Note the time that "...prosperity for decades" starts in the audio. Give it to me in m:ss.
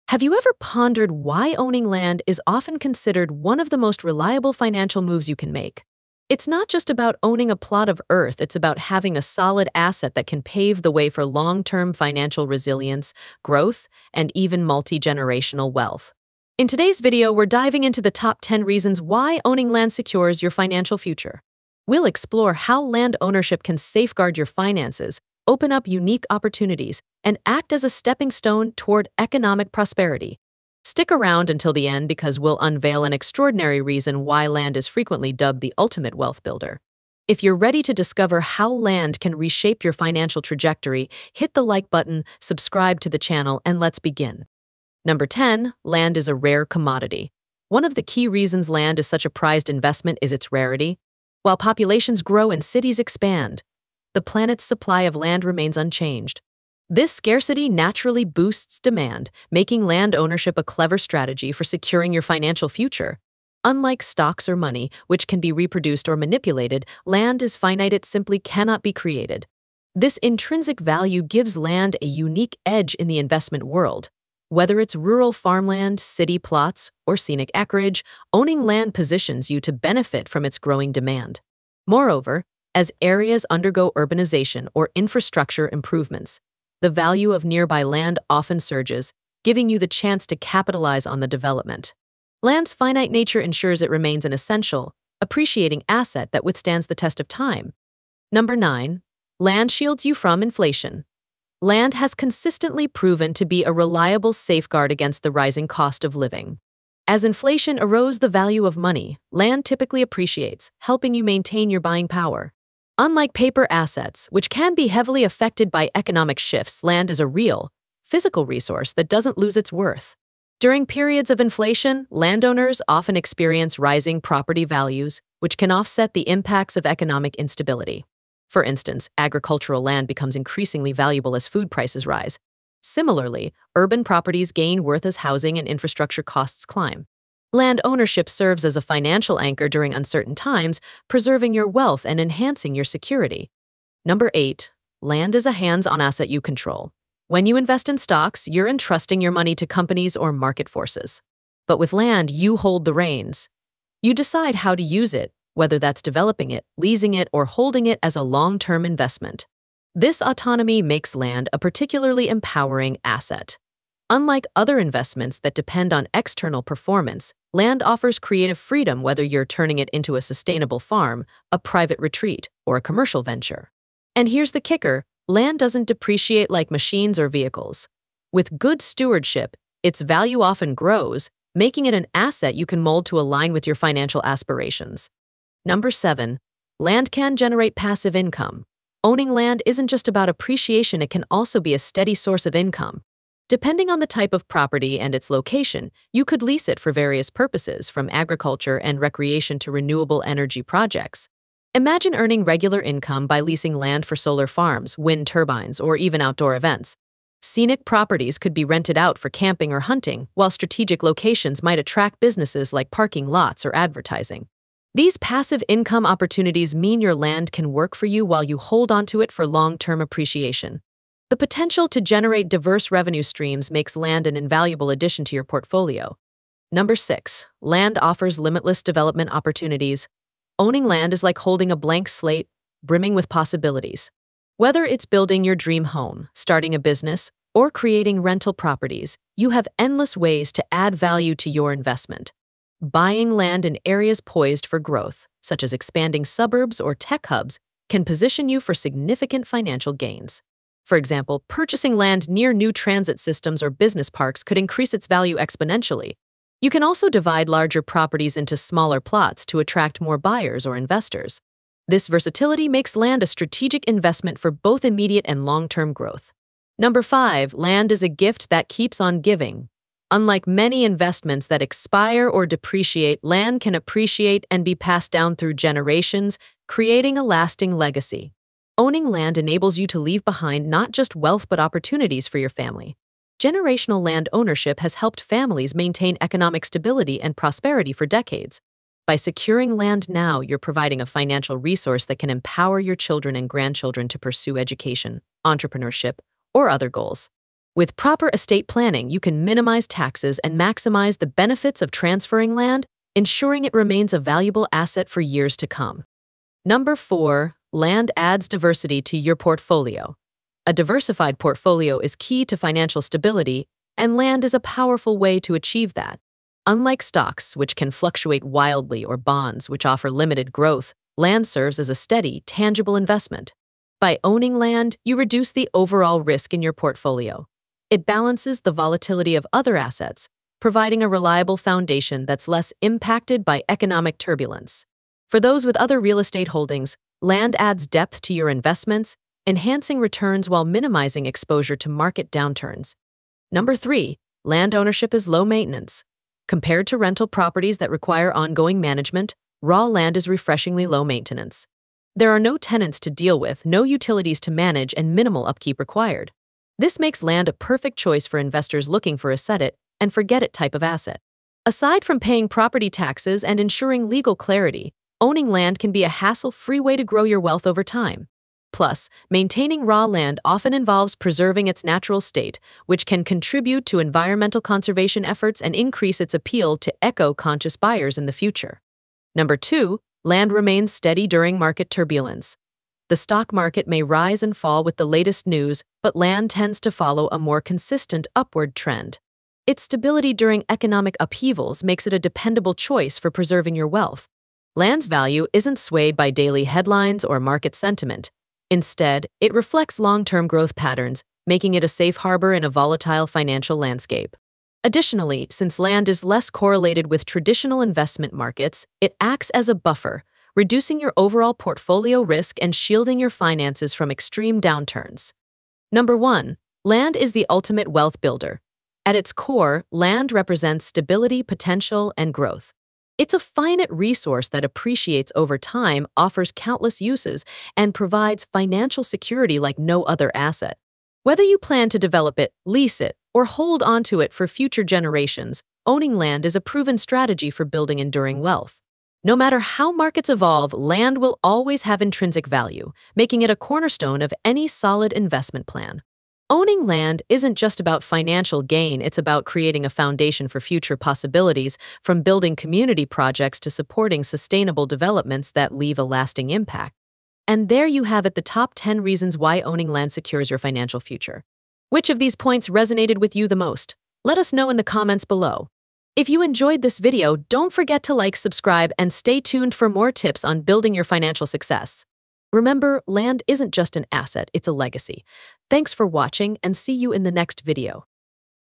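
4:47.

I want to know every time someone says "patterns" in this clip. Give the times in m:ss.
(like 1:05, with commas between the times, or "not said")
6:40.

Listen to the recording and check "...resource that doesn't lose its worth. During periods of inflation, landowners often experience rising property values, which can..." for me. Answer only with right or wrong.
right.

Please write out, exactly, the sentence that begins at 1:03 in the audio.
Unlike stocks or money, which can be reproduced or manipulated, land is finite, it simply cannot be created.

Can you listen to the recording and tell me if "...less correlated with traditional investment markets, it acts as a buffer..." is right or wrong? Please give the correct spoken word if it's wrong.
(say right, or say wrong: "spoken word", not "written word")
right.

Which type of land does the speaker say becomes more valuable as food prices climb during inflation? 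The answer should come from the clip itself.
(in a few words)
Agricultural land.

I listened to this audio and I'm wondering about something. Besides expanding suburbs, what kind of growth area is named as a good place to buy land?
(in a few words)
Tech hubs.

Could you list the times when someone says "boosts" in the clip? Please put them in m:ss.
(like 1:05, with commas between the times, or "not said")
0:58.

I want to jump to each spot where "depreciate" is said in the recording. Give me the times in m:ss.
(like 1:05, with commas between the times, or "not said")
2:55, 4:32.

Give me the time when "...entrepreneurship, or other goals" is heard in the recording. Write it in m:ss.
4:55.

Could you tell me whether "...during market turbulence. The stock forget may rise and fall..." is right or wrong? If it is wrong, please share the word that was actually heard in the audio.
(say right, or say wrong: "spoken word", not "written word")
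wrong: "market", not "forget".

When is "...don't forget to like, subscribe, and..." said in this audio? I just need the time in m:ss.
7:47.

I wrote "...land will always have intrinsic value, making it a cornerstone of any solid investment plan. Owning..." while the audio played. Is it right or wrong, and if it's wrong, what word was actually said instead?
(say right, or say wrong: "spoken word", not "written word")
right.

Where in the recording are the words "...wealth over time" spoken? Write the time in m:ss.
6:07.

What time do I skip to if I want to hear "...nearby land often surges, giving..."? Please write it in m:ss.
1:27.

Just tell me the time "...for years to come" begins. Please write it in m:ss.
5:05.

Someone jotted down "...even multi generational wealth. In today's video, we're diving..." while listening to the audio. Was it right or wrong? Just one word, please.
right.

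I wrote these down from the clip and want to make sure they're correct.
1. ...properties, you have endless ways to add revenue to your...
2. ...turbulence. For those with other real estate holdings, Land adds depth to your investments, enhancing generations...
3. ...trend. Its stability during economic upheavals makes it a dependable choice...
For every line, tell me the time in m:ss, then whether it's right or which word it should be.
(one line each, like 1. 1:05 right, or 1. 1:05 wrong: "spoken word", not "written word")
1. 3:58 wrong: "value", not "revenue"
2. 5:34 wrong: "returns", not "generations"
3. 6:28 right.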